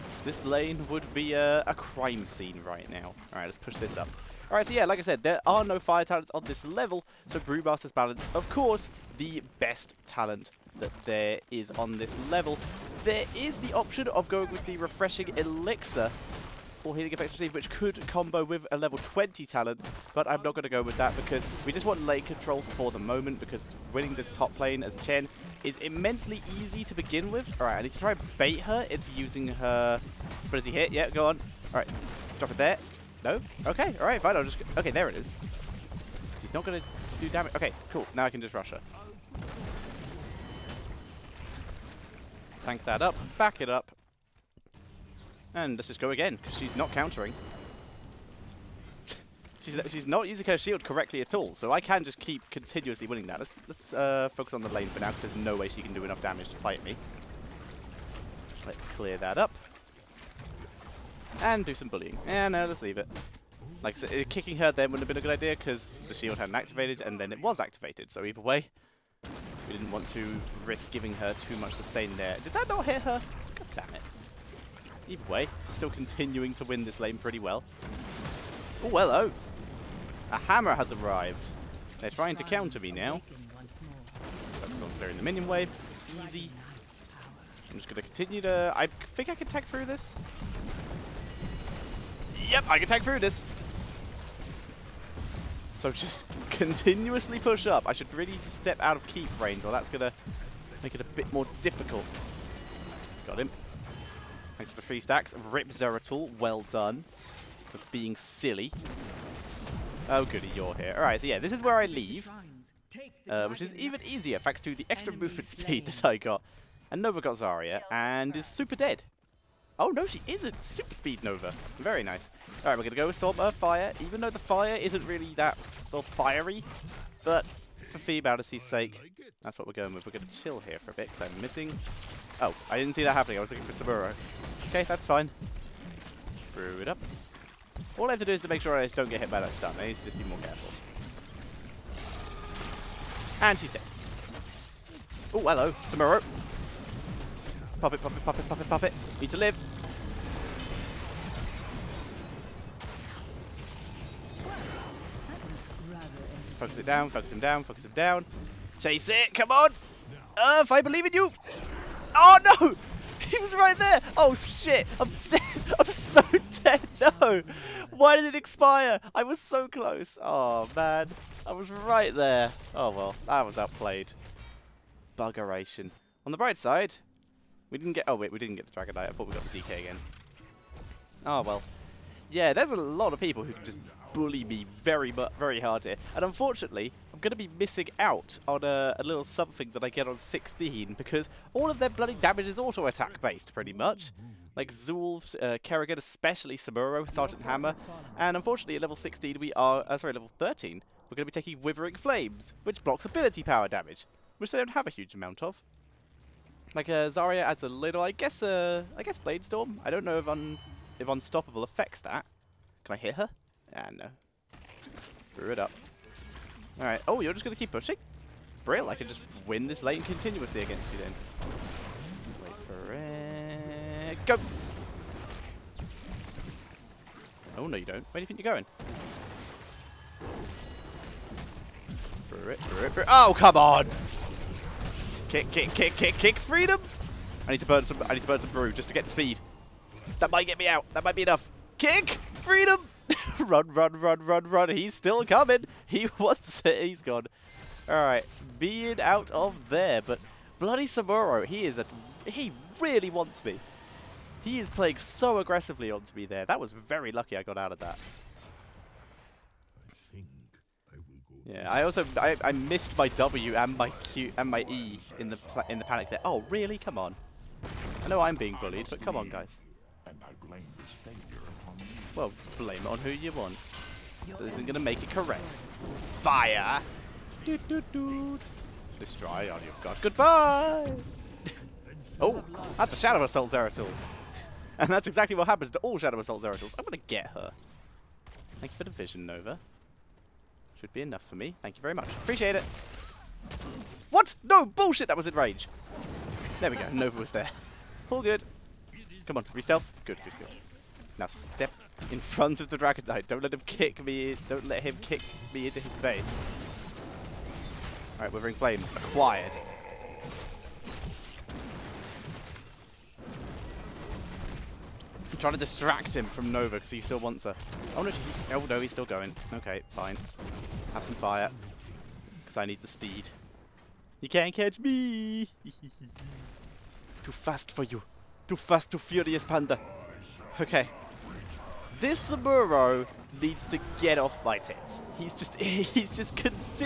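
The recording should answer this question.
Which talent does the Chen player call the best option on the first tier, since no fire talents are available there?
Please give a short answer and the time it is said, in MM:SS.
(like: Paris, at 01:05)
Brewmaster's Balance, at 00:07.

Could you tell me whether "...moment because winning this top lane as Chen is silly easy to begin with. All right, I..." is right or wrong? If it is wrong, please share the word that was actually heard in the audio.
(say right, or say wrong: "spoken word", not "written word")
wrong: "immensely", not "silly".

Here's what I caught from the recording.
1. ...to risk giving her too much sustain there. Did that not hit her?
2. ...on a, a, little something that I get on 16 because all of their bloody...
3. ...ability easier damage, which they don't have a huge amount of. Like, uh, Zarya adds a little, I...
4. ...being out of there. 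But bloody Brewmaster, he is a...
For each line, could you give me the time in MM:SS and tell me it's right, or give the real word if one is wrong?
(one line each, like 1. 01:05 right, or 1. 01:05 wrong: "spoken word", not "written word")
1. 01:10 right
2. 03:08 right
3. 03:23 wrong: "power", not "easier"
4. 04:08 wrong: "Samuro", not "Brewmaster".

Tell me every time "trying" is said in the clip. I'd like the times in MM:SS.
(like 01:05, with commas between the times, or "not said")
01:22, 05:15.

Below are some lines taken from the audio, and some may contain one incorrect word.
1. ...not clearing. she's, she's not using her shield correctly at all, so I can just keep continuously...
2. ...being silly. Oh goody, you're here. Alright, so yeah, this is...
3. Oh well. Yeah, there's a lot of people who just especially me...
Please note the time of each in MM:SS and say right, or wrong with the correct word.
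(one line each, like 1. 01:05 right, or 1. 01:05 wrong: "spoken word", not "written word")
1. 00:46 wrong: "countering", not "clearing"
2. 01:47 right
3. 03:01 wrong: "bully", not "especially".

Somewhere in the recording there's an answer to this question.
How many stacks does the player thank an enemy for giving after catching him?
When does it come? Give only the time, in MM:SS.
01:44.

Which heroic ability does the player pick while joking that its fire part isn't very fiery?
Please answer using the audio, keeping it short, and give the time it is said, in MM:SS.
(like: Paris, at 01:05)
Storm Earth Fire, at 02:03.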